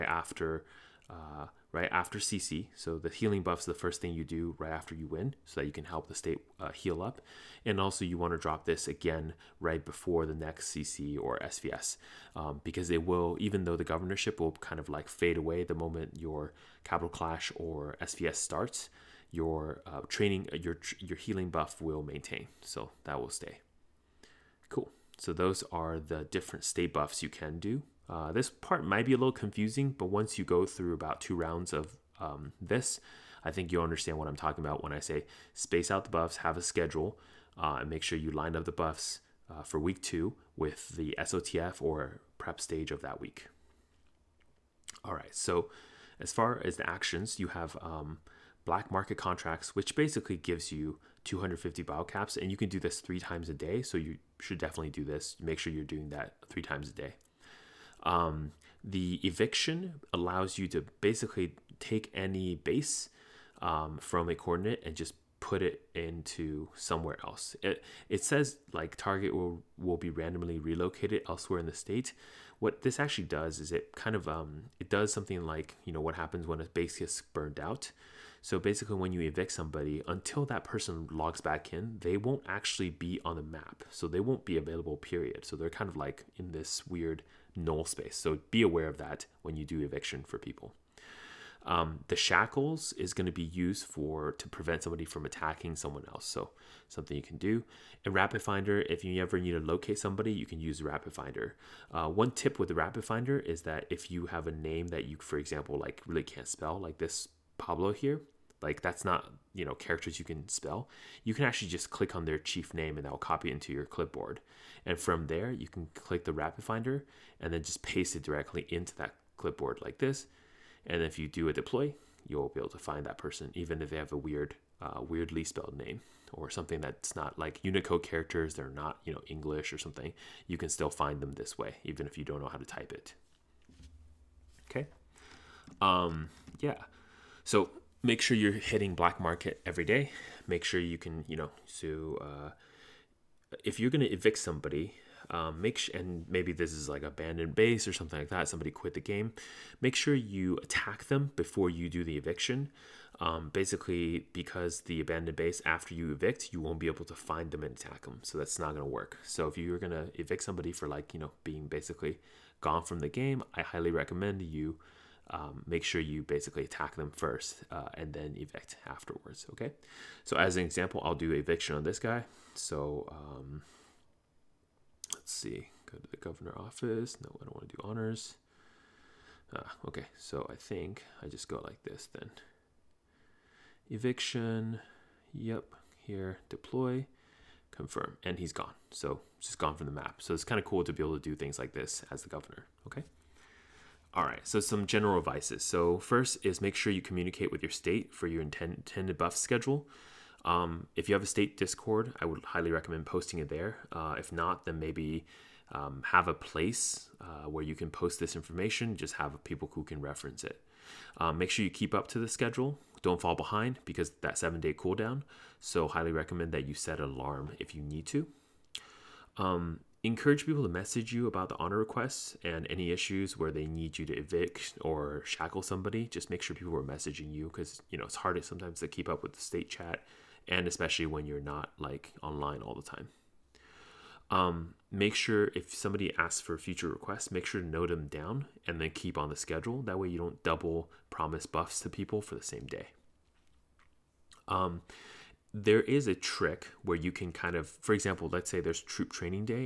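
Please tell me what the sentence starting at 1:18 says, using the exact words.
So basically, when you evict somebody, until that person logs back in, they won't actually be on the map.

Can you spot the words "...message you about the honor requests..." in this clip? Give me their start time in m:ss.
3:40.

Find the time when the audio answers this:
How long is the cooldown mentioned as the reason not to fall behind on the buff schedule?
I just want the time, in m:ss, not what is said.
3:34.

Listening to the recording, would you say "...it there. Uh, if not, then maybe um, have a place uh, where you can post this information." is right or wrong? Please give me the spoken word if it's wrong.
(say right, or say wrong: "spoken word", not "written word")
right.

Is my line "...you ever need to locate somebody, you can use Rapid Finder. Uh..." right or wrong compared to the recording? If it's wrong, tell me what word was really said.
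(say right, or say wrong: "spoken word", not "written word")
right.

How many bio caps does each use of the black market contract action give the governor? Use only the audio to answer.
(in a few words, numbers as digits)
250.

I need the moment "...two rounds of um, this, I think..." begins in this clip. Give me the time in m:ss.
0:31.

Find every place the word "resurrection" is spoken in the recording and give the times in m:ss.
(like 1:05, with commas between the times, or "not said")
not said.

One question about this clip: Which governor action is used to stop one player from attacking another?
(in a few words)
Shackles.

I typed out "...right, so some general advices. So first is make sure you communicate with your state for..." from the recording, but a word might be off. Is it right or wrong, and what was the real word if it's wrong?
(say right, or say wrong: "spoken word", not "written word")
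right.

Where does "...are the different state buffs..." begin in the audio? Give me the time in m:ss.
0:25.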